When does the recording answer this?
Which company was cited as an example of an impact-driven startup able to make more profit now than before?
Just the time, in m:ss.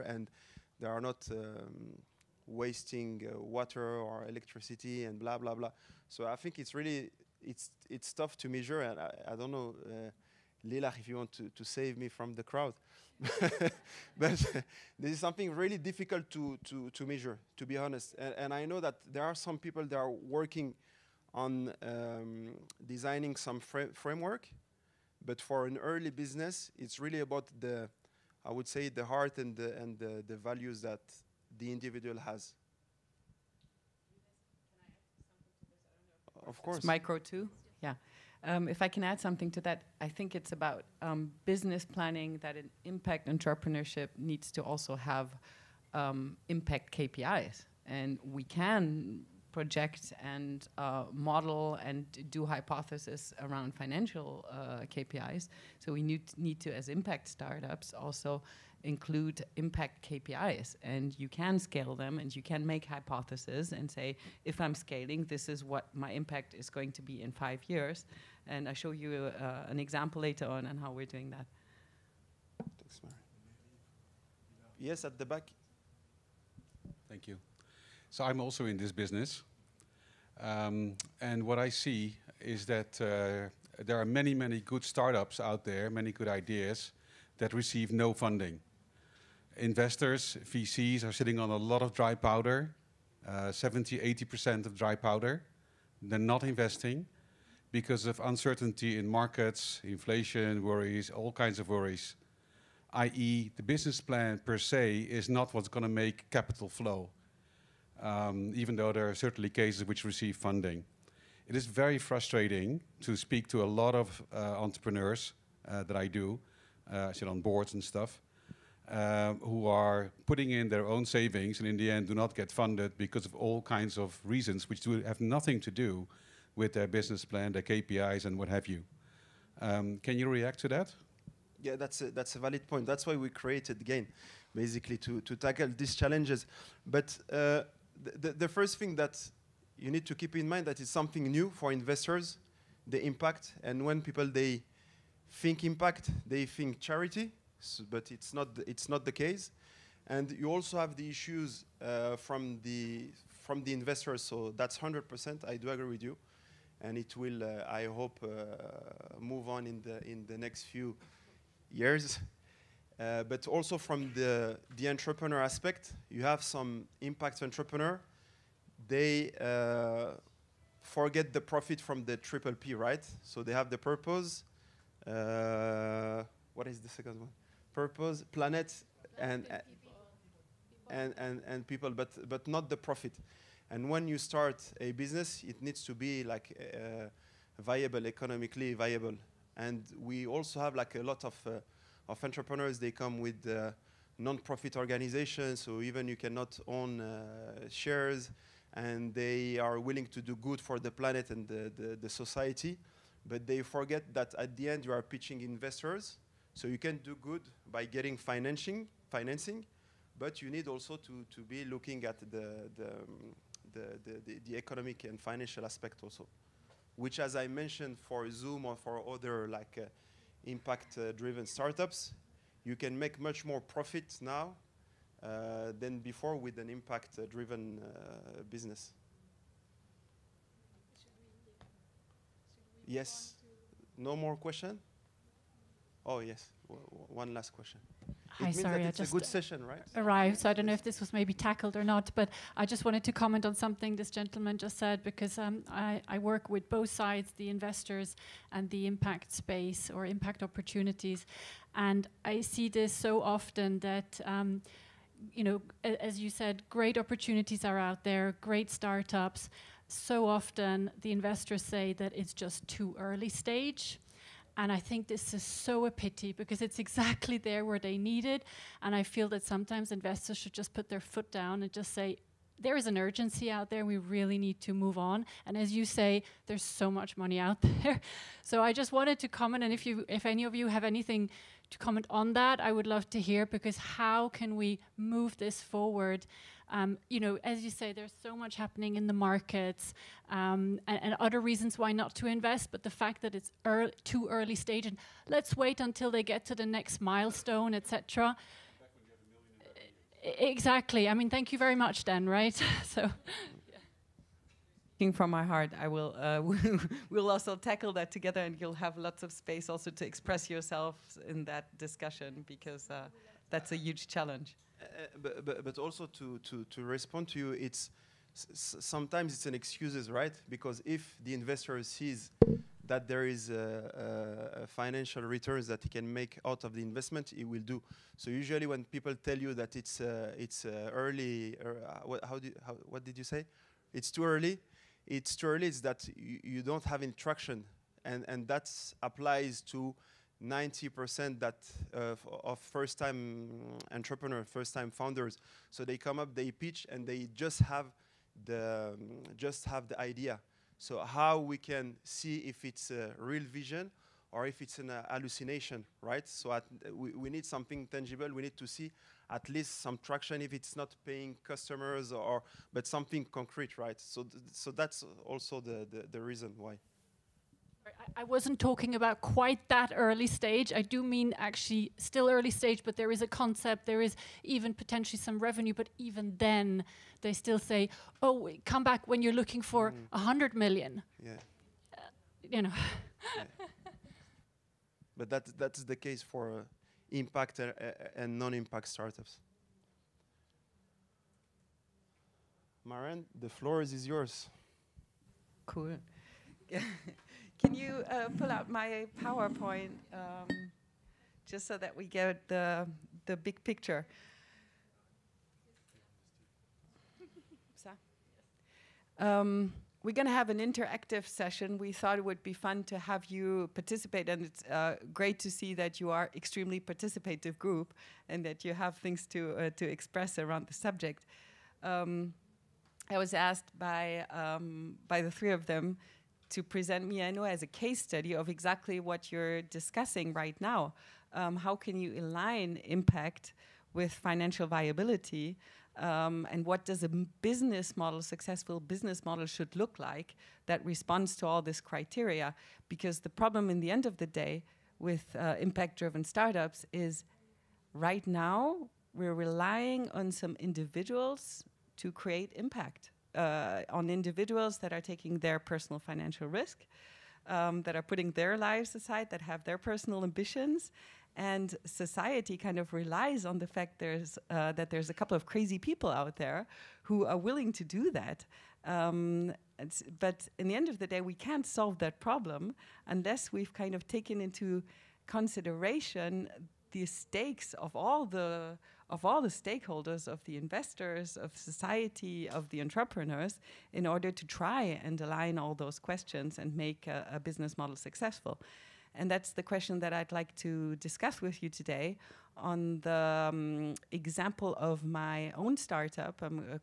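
3:38.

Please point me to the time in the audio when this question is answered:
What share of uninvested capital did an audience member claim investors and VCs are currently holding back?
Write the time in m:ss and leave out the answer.
1:33.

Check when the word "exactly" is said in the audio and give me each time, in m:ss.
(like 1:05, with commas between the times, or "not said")
4:26, 5:00, 7:08.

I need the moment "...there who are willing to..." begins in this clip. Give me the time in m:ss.
7:46.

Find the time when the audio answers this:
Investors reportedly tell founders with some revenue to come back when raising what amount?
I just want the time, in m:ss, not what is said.
6:20.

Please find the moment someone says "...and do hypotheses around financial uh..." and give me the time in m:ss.
0:51.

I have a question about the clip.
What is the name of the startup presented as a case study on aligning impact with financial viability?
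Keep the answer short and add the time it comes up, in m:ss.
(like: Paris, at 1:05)
Miano, at 7:07.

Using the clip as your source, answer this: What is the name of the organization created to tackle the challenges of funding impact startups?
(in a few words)
GAIN.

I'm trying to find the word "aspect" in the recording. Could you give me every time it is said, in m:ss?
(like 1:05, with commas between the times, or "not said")
2:45, 3:35.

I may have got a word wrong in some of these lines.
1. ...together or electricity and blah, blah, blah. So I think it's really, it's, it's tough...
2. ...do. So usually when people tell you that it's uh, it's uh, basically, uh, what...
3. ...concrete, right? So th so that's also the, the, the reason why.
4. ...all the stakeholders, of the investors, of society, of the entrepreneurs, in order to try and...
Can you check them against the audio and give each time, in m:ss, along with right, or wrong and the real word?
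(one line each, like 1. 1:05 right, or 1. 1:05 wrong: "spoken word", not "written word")
1. 0:03 wrong: "water", not "together"
2. 5:27 wrong: "early", not "basically"
3. 6:03 right
4. 7:59 right.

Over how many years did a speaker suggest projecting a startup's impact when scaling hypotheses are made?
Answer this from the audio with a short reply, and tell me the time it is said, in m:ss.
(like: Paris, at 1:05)
5 years, at 1:07.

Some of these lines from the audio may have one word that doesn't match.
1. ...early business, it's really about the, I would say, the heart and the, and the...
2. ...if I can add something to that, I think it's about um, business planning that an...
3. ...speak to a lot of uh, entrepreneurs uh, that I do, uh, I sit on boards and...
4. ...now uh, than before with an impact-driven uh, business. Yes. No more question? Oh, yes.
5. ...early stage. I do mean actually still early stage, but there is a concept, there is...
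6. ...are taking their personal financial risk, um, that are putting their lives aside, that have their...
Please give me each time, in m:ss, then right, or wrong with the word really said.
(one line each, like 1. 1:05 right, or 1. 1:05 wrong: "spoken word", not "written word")
1. 0:25 right
2. 0:38 right
3. 1:53 right
4. 3:44 right
5. 6:09 right
6. 7:34 right.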